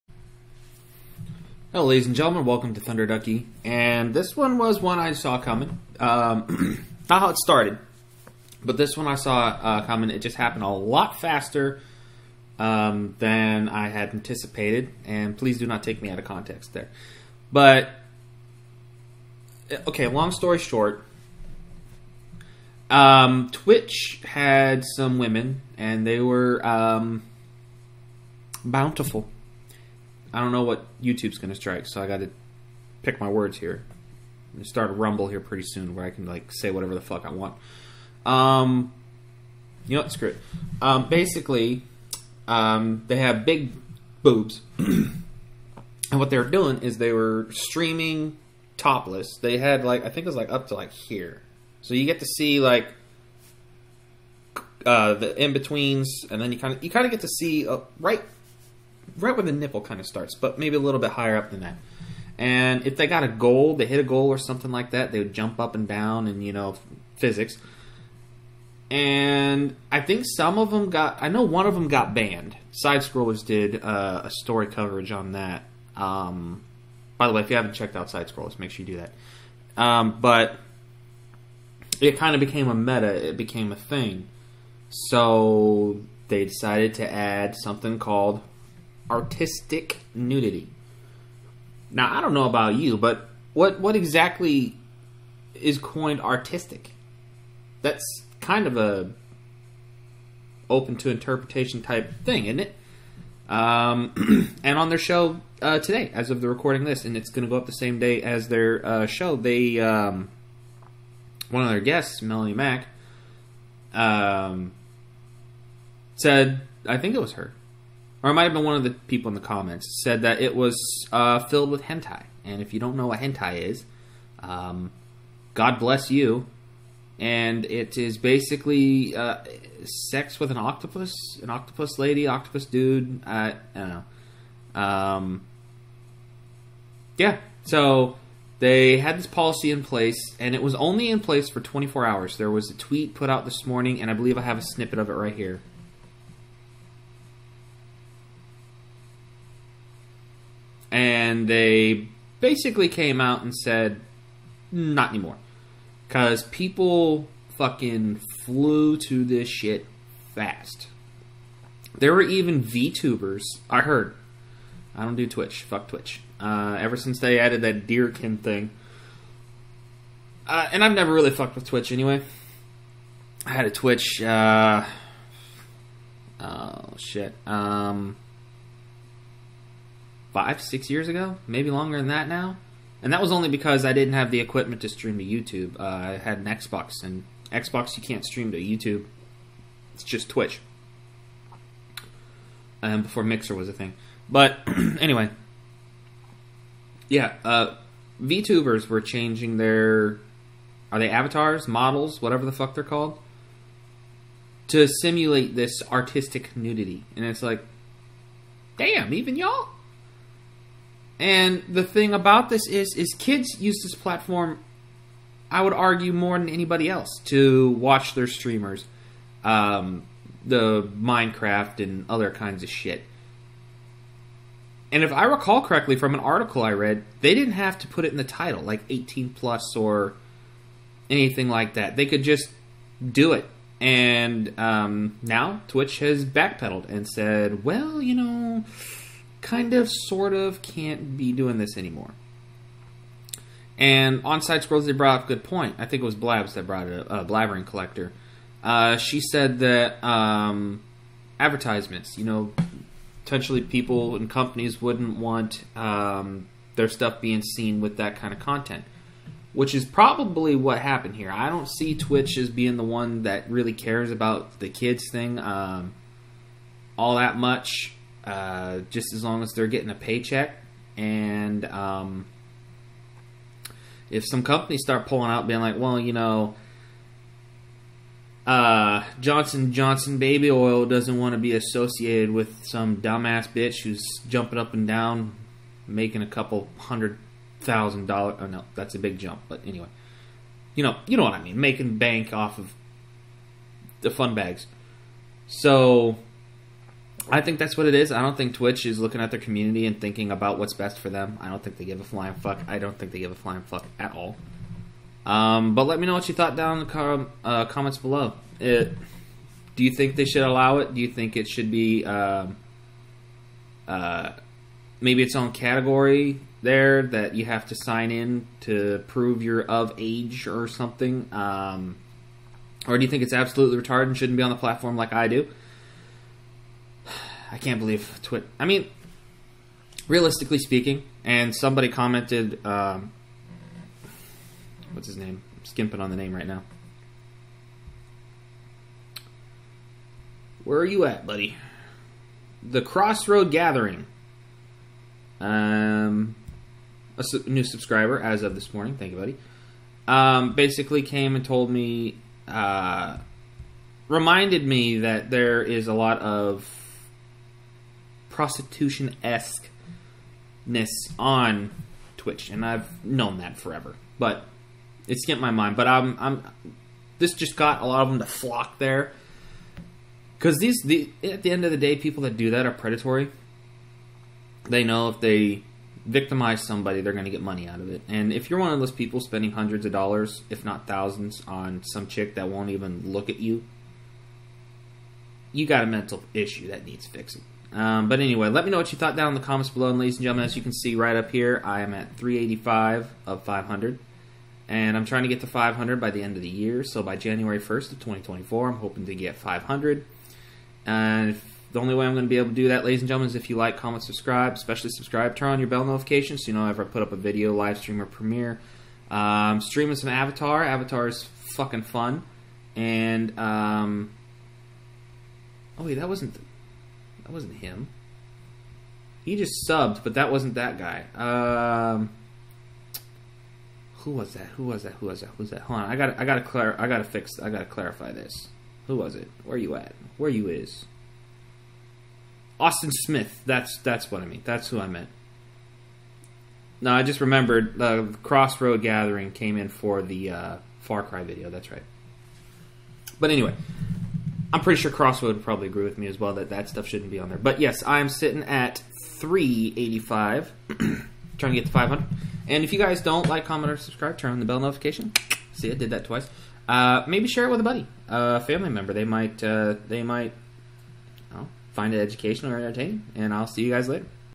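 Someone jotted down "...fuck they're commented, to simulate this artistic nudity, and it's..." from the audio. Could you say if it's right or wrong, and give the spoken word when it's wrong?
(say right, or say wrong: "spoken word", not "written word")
wrong: "called", not "commented".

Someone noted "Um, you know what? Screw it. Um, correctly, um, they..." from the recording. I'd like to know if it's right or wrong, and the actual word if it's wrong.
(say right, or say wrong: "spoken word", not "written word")
wrong: "basically", not "correctly".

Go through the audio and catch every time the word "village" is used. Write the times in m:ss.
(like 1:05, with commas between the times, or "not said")
not said.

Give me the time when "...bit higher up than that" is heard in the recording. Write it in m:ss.
1:00.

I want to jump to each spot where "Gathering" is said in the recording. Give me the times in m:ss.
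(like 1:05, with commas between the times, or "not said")
5:43, 7:18.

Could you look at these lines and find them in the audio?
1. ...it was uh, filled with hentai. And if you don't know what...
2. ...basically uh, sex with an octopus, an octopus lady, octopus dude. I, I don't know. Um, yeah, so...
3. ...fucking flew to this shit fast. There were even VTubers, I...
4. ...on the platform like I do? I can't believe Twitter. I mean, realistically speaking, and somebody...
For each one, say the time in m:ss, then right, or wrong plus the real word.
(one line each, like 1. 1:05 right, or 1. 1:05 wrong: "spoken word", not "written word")
1. 2:00 right
2. 2:08 right
3. 2:37 right
4. 5:24 right.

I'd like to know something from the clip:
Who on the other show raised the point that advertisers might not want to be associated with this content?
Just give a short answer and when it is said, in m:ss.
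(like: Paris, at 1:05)
Blabbering Collector, at 4:07.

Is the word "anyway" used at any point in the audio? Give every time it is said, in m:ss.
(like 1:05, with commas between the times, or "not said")
2:51, 3:14, 4:49, 6:28, 7:23.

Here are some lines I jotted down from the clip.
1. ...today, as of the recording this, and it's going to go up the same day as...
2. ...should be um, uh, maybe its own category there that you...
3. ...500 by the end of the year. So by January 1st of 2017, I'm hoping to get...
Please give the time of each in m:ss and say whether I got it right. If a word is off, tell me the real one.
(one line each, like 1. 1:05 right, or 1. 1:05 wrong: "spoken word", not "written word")
1. 1:45 right
2. 5:11 right
3. 6:35 wrong: "2024", not "2017".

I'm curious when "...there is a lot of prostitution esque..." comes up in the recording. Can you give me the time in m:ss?
5:55.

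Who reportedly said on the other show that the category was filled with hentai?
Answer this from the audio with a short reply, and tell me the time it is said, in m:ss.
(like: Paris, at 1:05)
Melanie Mack, at 1:52.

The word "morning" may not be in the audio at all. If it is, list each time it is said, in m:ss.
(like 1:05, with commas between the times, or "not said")
2:23, 5:48.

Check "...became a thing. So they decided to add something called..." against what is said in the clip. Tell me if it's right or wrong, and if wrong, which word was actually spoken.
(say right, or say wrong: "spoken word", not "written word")
right.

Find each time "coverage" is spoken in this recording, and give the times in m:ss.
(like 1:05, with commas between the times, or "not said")
1:14.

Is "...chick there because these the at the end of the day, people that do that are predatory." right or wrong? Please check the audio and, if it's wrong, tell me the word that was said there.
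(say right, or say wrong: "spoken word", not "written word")
wrong: "flock", not "chick".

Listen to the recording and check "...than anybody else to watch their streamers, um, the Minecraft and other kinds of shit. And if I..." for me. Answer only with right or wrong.
right.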